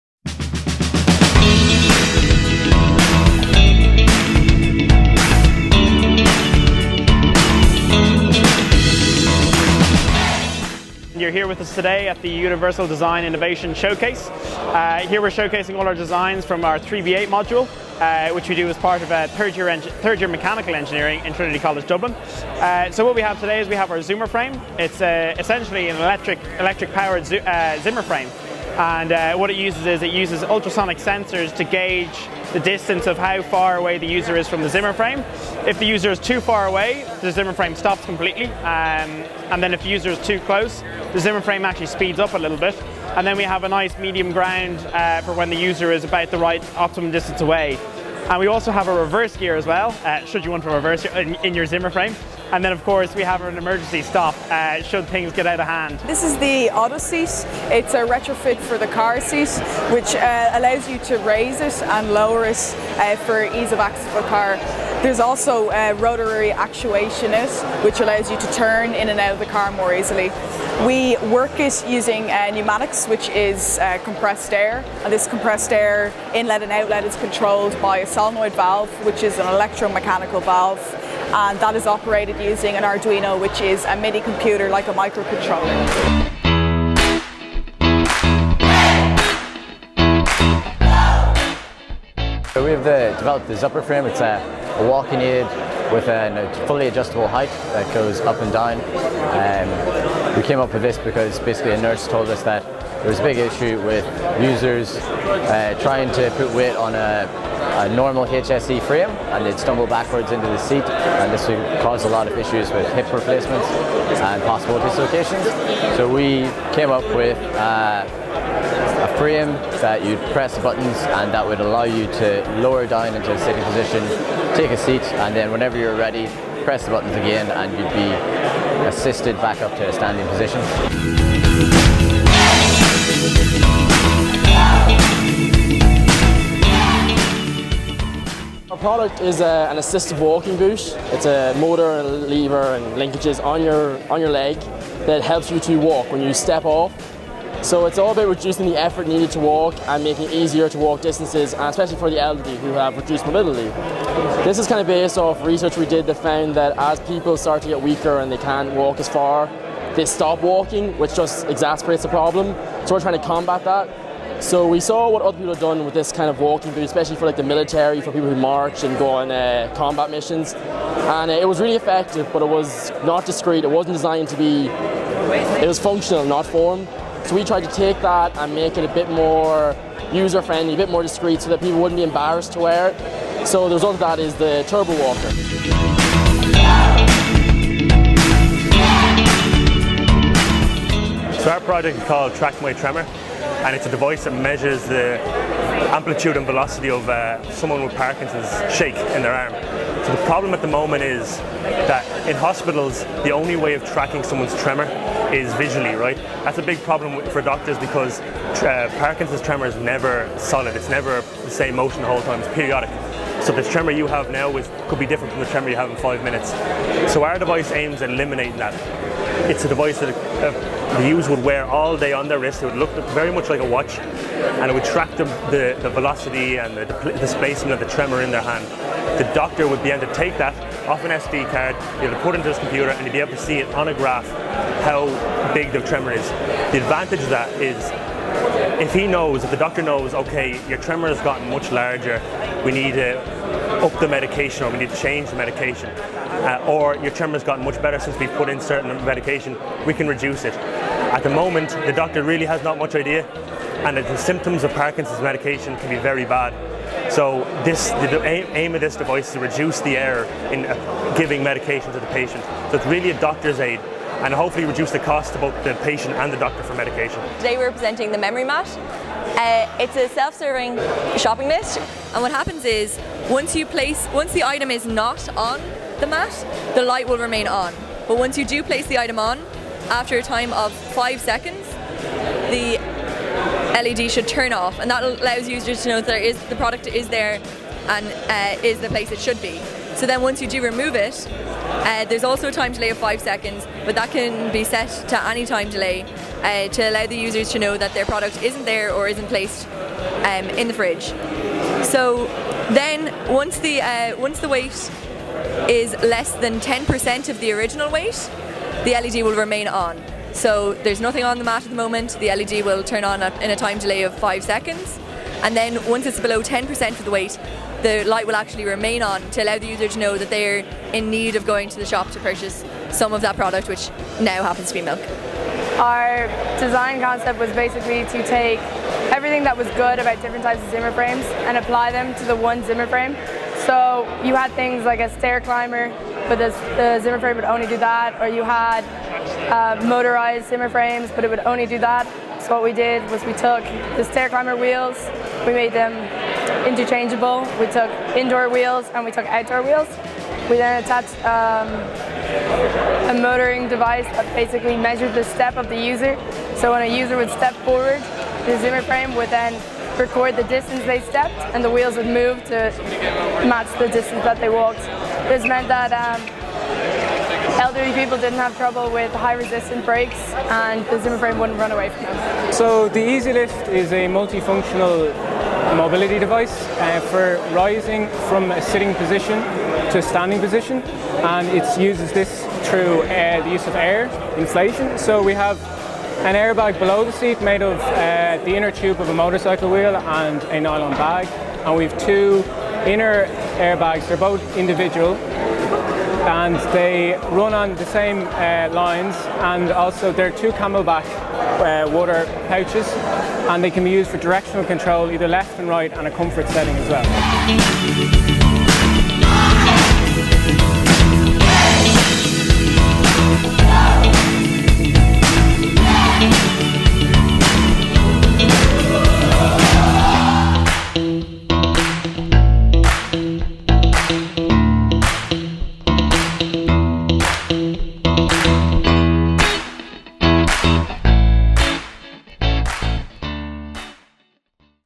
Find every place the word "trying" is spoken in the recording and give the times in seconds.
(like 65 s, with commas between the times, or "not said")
105 s, 163 s.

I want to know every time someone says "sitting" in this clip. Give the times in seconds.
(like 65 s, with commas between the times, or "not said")
123 s, 378 s.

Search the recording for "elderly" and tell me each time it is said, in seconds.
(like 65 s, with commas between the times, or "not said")
152 s, 367 s.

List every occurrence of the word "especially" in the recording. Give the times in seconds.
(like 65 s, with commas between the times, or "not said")
151 s, 166 s.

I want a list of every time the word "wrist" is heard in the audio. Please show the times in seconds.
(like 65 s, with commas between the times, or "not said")
222 s.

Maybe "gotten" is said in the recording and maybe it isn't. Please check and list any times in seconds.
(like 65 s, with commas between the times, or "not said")
241 s, 247 s.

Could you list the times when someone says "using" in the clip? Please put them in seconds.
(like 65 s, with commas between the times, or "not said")
71 s, 82 s.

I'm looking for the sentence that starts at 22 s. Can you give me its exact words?
Uh, so what we have today is we have our Zoomer frame.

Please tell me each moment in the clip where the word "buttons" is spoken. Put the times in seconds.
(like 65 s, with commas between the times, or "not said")
120 s, 126 s.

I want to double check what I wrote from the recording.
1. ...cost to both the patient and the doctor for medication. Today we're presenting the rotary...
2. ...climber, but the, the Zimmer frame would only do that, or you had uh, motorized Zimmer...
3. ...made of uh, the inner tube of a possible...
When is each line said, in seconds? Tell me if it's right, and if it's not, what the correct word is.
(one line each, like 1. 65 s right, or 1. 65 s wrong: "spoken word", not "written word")
1. 264 s wrong: "memory", not "rotary"
2. 335 s right
3. 387 s wrong: "motorcycle", not "possible".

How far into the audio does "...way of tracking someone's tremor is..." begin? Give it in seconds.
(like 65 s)
203 s.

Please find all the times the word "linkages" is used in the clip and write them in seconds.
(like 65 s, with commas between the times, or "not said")
142 s.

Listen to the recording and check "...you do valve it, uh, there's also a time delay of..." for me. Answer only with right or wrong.
wrong.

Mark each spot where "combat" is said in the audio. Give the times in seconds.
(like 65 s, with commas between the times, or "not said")
163 s, 169 s.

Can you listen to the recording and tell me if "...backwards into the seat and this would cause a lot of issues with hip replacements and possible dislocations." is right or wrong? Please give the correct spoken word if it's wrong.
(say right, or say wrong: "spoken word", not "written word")
right.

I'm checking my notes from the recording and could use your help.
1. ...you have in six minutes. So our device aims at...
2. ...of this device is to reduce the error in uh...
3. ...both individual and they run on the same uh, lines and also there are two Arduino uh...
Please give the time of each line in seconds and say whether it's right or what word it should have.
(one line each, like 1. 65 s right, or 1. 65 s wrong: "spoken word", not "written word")
1. 215 s wrong: "five", not "six"
2. 258 s right
3. 394 s wrong: "CamelBak", not "Arduino".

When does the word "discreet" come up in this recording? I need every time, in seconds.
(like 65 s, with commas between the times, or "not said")
173 s, 181 s.